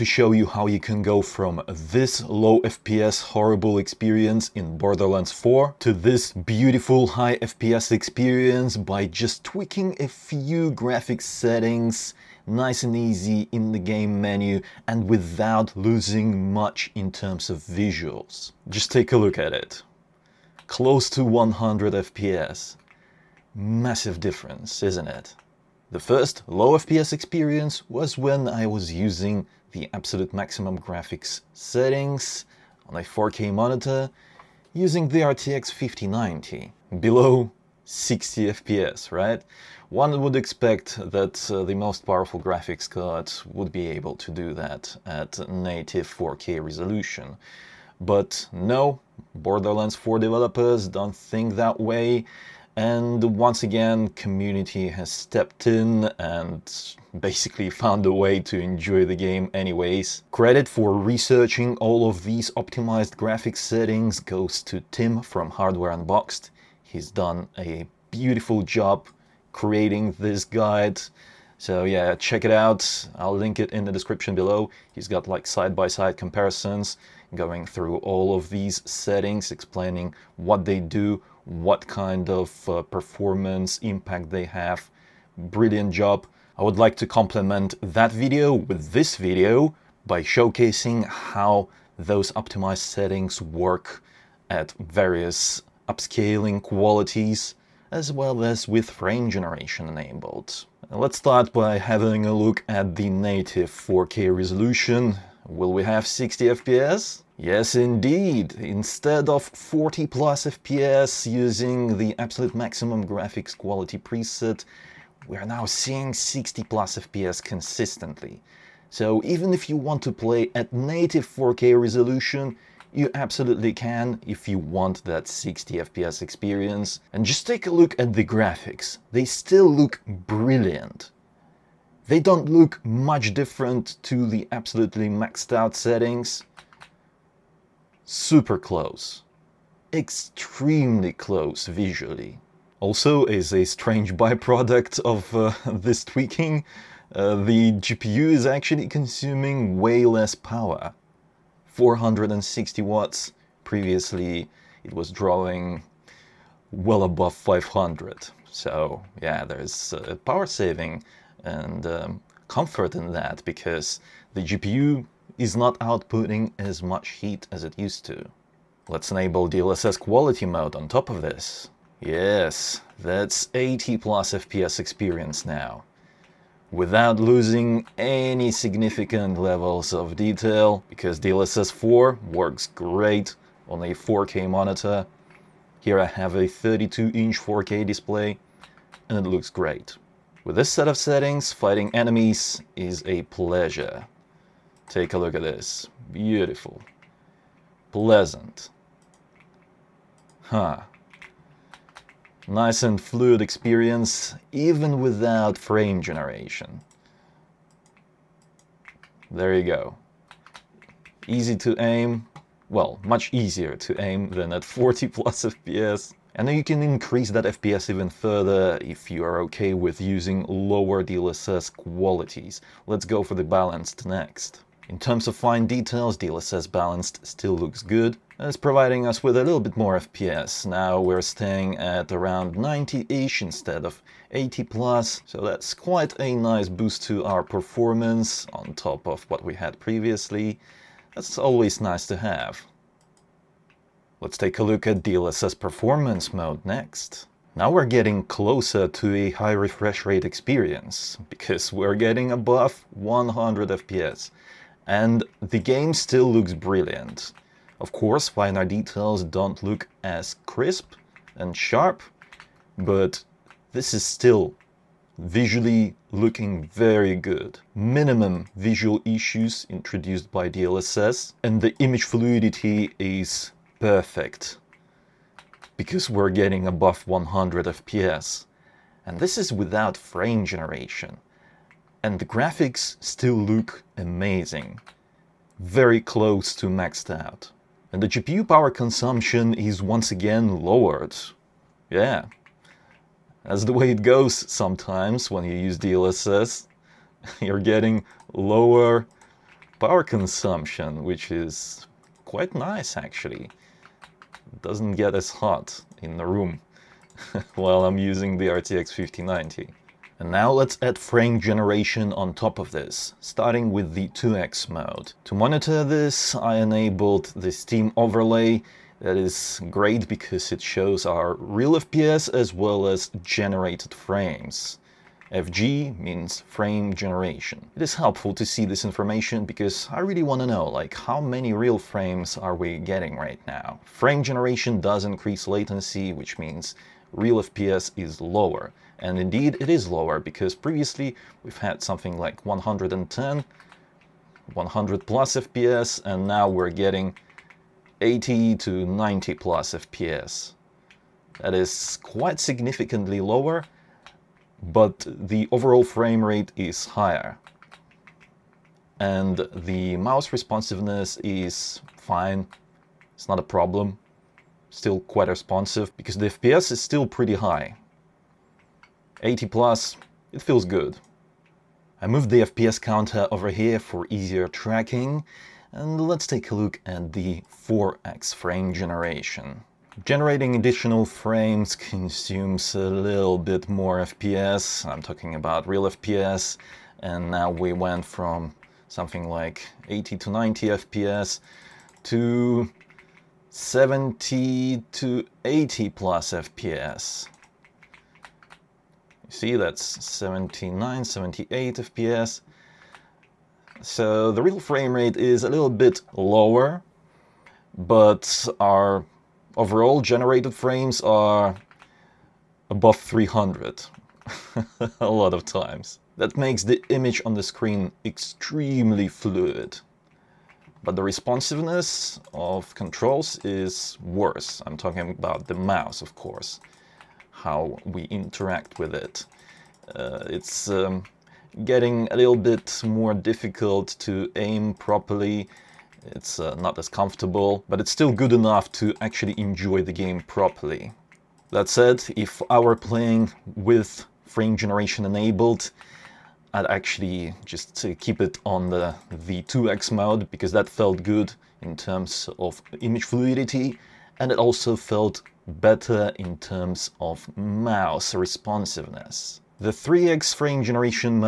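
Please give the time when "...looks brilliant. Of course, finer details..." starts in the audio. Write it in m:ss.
4:16.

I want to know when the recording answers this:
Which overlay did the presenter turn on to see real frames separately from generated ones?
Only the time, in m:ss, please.
5:17.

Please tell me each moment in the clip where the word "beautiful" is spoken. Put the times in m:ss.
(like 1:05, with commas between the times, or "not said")
0:06, 1:08, 3:16.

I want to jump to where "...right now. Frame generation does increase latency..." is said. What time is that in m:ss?
5:33.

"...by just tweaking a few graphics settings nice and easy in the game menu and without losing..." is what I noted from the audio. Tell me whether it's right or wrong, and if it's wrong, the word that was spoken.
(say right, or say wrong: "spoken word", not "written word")
right.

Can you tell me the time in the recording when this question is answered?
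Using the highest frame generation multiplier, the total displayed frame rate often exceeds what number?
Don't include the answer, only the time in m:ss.
6:52.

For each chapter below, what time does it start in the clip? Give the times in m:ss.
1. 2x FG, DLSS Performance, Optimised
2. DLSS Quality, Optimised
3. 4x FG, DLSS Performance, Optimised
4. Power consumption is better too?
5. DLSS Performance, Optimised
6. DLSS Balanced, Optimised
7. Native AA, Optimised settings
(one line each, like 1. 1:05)
1. 5:09
2. 2:48
3. 6:11
4. 2:22
5. 4:03
6. 3:35
7. 1:40.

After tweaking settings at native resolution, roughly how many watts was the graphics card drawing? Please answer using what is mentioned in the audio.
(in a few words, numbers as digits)
460 watts.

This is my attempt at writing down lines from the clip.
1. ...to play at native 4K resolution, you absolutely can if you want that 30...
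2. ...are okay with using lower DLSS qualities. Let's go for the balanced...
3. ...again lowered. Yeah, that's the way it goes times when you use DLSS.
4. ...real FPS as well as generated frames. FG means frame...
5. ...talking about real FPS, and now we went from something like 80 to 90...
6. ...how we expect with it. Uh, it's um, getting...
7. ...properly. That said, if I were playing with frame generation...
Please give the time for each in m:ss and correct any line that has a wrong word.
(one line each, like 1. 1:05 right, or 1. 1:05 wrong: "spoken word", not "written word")
1. 2:00 wrong: "60", not "30"
2. 3:39 right
3. 4:50 wrong: "sometimes", not "times"
4. 5:21 right
5. 6:25 right
6. 7:07 wrong: "interact", not "expect"
7. 7:20 right.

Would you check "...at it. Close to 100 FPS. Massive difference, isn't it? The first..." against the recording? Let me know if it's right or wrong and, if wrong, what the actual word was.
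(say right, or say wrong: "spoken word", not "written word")
right.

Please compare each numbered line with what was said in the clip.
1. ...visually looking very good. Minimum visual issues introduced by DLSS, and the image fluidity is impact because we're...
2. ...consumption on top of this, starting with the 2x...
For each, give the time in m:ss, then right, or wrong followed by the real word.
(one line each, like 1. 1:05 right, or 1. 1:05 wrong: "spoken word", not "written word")
1. 4:25 wrong: "perfect", not "impact"
2. 5:11 wrong: "generation", not "consumption".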